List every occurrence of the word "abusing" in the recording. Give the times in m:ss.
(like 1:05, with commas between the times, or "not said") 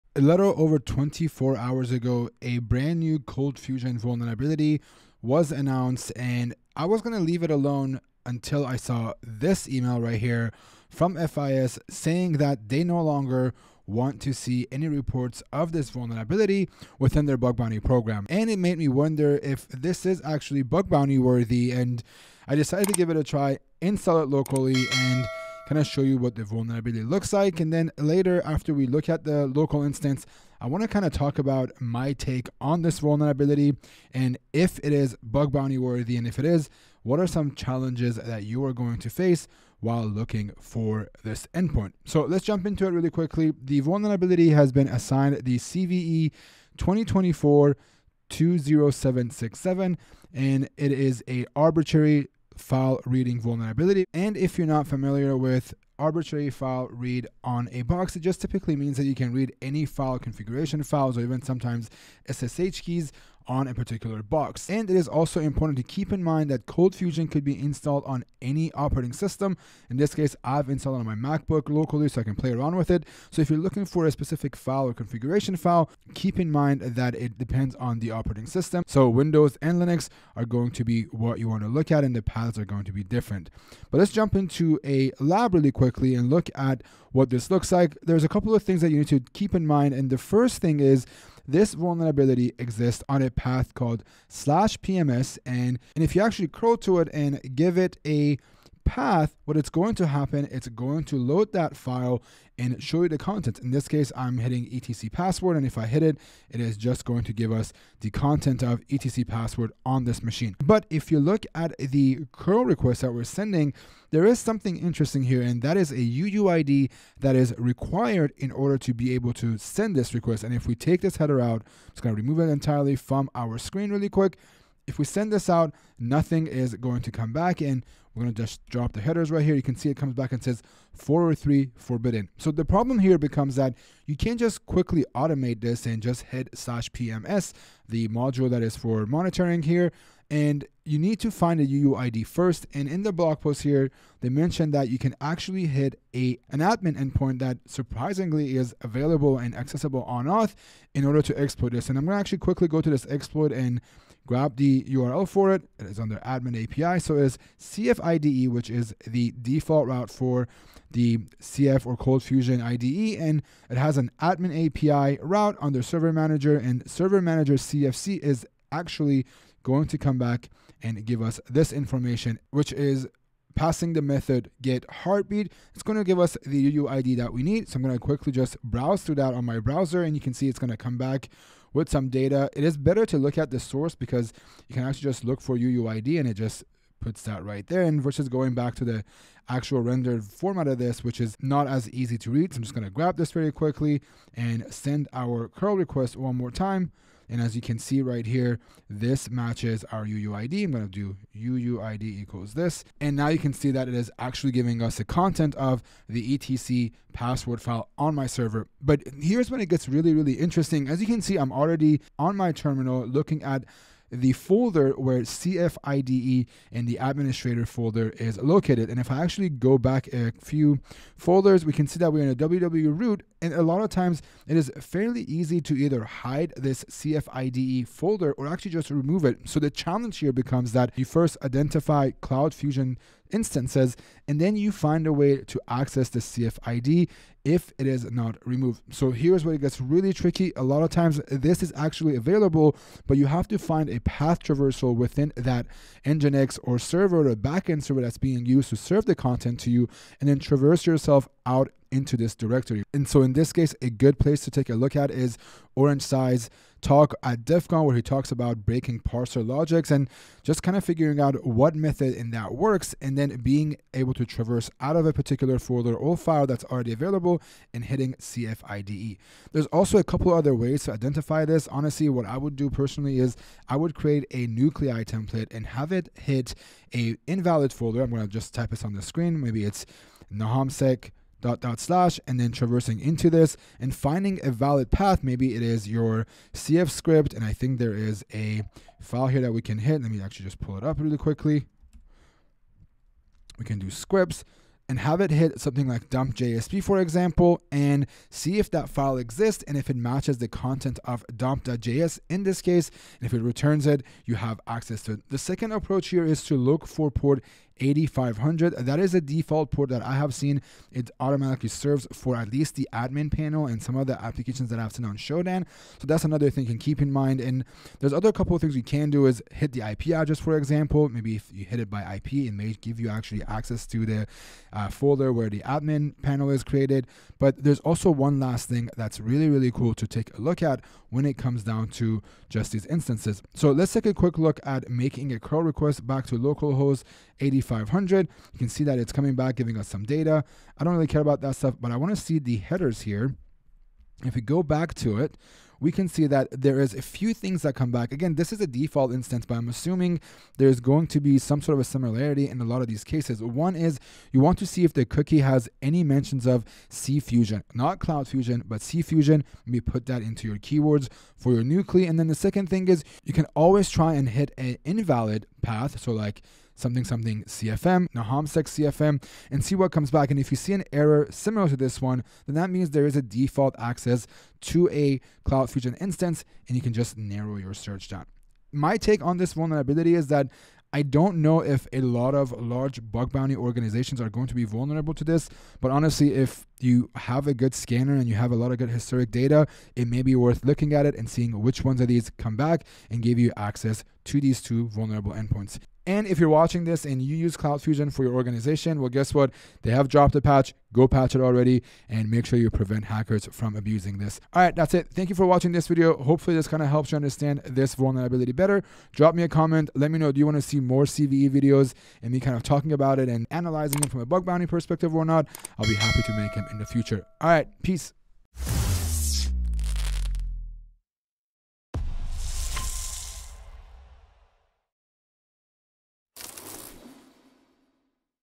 6:43.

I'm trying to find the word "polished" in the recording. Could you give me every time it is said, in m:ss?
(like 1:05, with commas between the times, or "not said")
not said.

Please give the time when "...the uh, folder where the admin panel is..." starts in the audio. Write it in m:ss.
5:24.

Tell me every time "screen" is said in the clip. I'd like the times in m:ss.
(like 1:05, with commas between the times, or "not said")
2:03, 4:39.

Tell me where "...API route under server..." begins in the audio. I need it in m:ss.
2:44.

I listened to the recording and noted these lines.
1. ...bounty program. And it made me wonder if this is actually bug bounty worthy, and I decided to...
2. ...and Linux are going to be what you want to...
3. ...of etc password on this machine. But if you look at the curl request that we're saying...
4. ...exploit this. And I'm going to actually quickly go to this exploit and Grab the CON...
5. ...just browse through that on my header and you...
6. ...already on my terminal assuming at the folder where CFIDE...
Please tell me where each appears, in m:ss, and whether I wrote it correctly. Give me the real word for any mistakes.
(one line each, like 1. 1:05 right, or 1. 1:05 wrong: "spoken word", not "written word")
1. 0:17 right
2. 1:19 right
3. 1:48 wrong: "sending", not "saying"
4. 2:31 wrong: "URL", not "CON"
5. 2:58 wrong: "browser", not "header"
6. 3:31 wrong: "looking", not "assuming".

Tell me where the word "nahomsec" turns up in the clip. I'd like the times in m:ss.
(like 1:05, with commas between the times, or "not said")
4:40, 6:08.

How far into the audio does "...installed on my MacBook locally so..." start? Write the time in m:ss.
1:10.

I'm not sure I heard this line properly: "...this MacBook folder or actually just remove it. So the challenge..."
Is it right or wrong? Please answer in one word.
wrong.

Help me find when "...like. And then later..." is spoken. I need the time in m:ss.
0:27.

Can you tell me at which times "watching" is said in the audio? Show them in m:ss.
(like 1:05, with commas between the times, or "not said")
6:36, 6:45.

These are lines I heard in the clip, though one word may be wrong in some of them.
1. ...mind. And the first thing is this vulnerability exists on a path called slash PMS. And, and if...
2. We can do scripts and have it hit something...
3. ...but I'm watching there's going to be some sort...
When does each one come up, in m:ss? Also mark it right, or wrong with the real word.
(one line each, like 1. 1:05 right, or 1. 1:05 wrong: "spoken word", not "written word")
1. 1:29 right
2. 4:53 right
3. 5:49 wrong: "assuming", not "watching".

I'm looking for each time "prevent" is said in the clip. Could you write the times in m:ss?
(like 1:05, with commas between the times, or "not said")
6:42.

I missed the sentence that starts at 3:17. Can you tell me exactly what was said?
And as you can see right here, this matches our UUID.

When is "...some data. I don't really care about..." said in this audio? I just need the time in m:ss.
5:39.